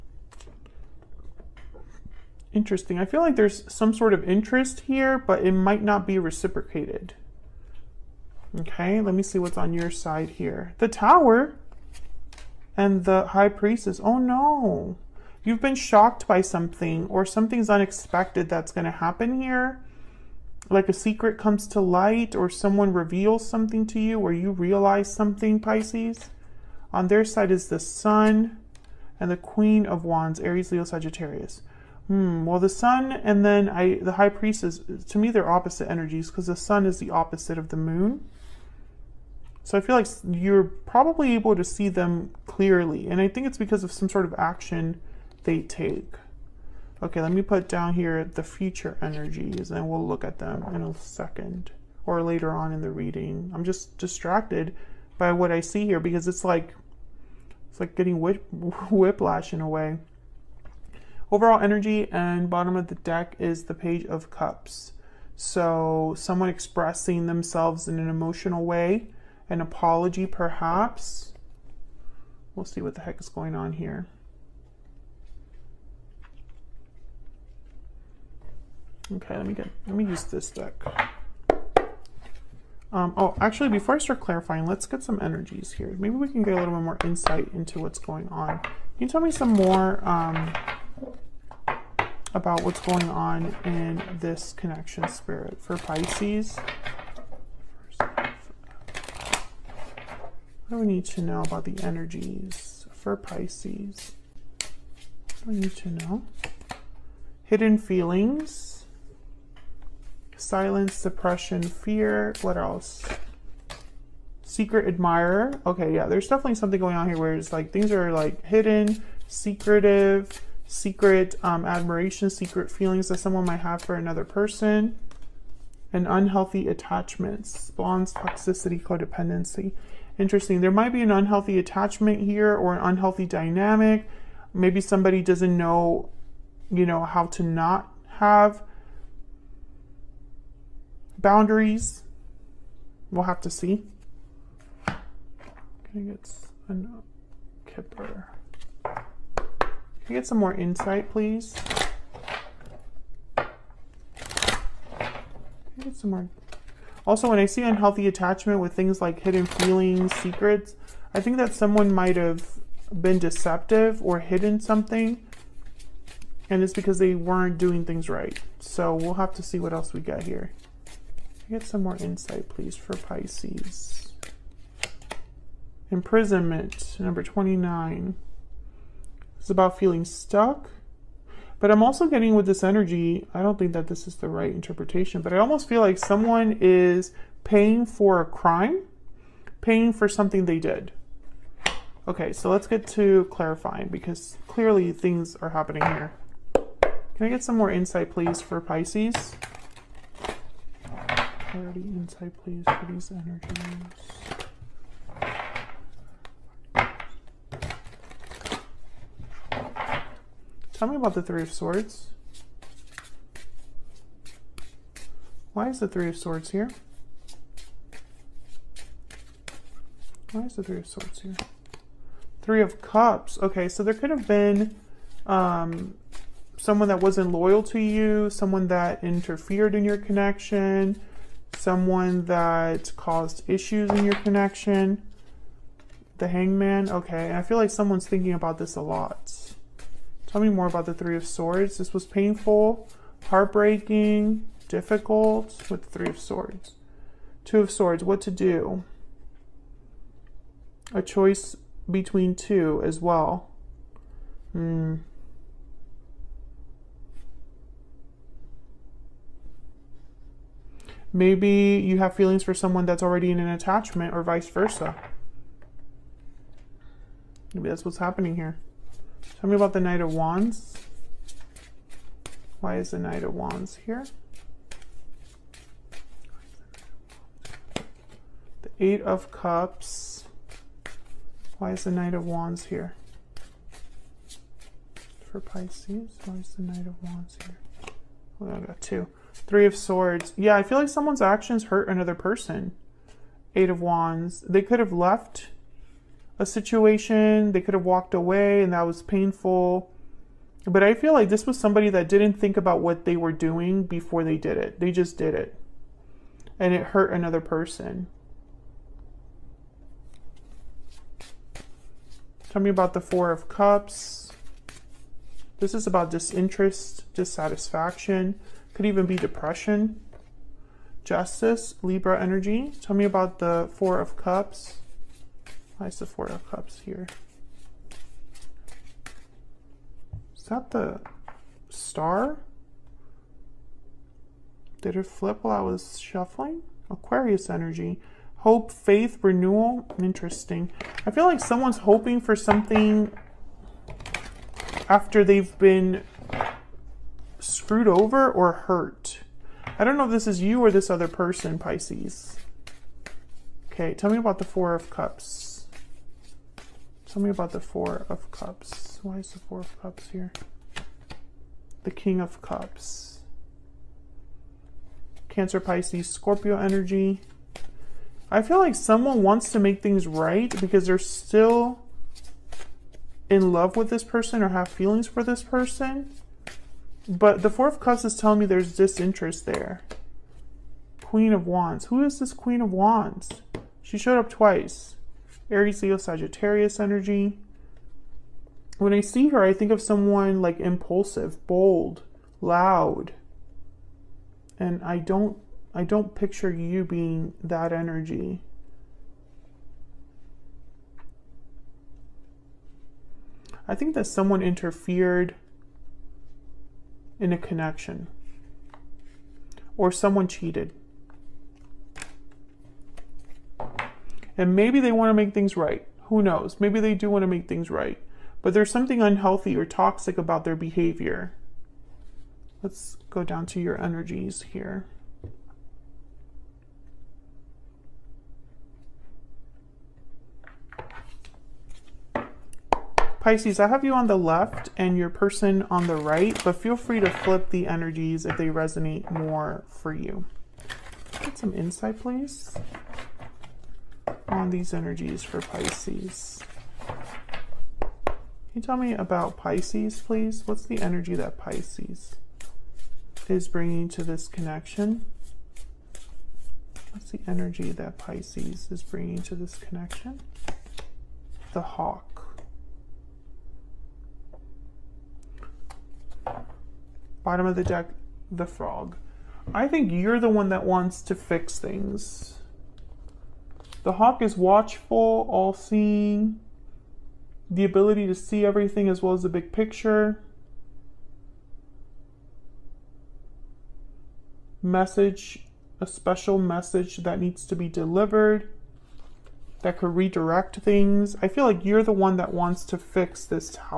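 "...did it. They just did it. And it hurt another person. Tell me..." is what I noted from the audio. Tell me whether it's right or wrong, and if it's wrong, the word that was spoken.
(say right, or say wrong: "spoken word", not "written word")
right.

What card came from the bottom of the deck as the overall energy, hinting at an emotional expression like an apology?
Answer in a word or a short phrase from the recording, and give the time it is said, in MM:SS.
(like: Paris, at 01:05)
Page of Cups, at 01:03.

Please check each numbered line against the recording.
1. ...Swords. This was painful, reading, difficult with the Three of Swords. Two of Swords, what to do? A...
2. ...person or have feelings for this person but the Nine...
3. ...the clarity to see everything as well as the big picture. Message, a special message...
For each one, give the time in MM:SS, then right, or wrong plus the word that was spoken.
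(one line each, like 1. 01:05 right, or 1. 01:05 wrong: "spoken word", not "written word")
1. 04:01 wrong: "heartbreaking", not "reading"
2. 06:14 wrong: "Four", not "Nine"
3. 07:57 wrong: "ability", not "clarity".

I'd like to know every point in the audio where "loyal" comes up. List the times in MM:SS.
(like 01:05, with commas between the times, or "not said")
03:47.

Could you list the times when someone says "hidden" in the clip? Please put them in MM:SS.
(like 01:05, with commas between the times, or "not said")
01:47, 01:58, 02:39, 02:44.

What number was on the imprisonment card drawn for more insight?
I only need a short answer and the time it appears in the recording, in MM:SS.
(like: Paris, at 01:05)
29, at 02:56.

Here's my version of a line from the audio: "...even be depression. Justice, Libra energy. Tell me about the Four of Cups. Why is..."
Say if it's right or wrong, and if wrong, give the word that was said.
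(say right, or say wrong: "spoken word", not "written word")
right.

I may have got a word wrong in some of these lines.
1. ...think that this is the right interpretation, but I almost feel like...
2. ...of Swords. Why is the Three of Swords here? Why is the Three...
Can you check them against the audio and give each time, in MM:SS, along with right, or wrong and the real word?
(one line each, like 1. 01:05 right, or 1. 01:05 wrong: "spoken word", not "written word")
1. 03:03 right
2. 03:31 right.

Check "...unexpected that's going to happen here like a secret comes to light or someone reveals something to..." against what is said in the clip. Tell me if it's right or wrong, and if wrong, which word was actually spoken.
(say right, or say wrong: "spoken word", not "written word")
right.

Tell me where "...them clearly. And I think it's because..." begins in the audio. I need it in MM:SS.
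00:41.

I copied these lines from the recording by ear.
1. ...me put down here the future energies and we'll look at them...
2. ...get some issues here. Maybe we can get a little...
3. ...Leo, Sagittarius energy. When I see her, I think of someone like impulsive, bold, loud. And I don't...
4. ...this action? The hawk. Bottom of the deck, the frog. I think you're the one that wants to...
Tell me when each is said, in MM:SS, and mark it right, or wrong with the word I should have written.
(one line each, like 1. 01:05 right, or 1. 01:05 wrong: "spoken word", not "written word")
1. 00:47 right
2. 01:24 wrong: "energies", not "issues"
3. 06:25 right
4. 07:39 wrong: "connection", not "action".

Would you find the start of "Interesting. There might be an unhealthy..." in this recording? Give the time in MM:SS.
02:10.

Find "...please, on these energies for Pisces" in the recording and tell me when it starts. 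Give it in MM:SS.
07:21.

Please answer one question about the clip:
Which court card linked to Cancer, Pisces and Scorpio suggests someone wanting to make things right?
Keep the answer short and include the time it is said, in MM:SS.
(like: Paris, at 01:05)
King of Cups, at 06:01.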